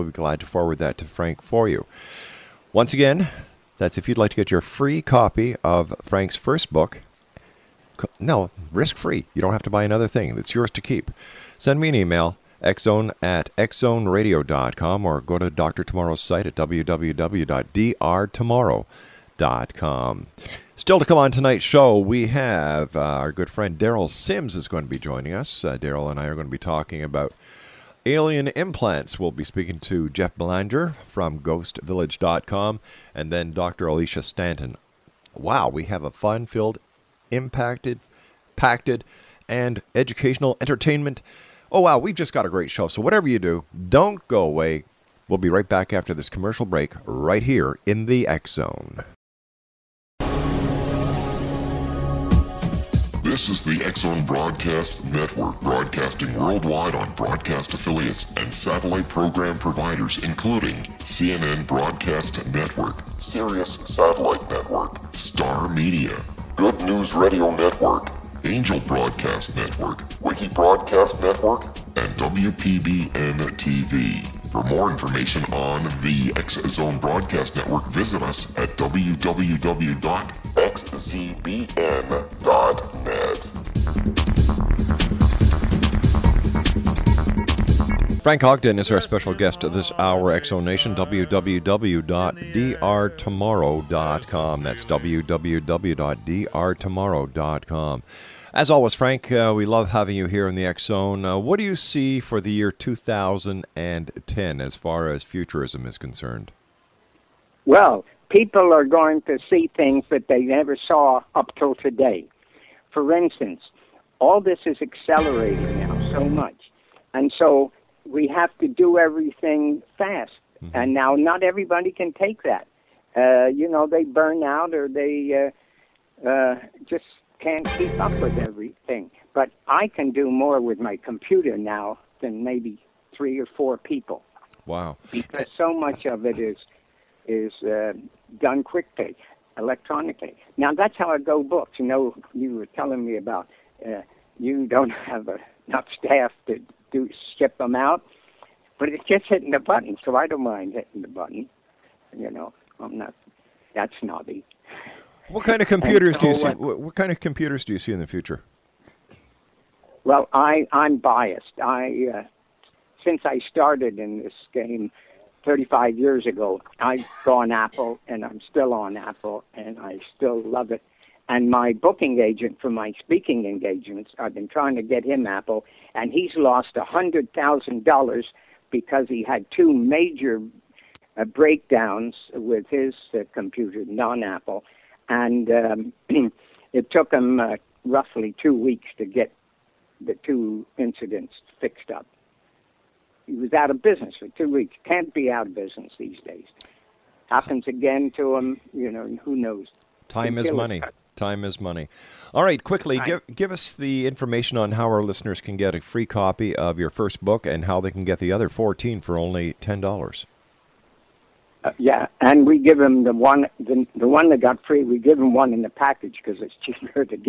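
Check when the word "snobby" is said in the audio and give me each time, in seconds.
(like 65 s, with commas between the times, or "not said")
153 s.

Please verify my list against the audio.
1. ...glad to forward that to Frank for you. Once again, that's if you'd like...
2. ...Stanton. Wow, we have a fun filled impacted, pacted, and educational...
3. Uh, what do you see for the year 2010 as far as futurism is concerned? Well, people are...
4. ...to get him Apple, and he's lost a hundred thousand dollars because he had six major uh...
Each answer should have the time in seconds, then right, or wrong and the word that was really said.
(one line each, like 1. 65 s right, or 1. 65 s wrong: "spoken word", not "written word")
1. 0 s right
2. 34 s right
3. 101 s right
4. 174 s wrong: "two", not "six".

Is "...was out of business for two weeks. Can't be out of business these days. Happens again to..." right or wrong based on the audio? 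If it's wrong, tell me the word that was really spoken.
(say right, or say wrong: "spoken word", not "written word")
right.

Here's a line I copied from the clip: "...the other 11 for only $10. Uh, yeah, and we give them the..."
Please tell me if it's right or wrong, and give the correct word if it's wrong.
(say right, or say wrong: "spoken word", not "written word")
wrong: "14", not "11".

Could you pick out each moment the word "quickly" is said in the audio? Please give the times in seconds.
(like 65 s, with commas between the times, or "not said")
138 s, 202 s.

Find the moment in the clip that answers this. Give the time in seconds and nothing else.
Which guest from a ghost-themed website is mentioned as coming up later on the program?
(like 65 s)
30 s.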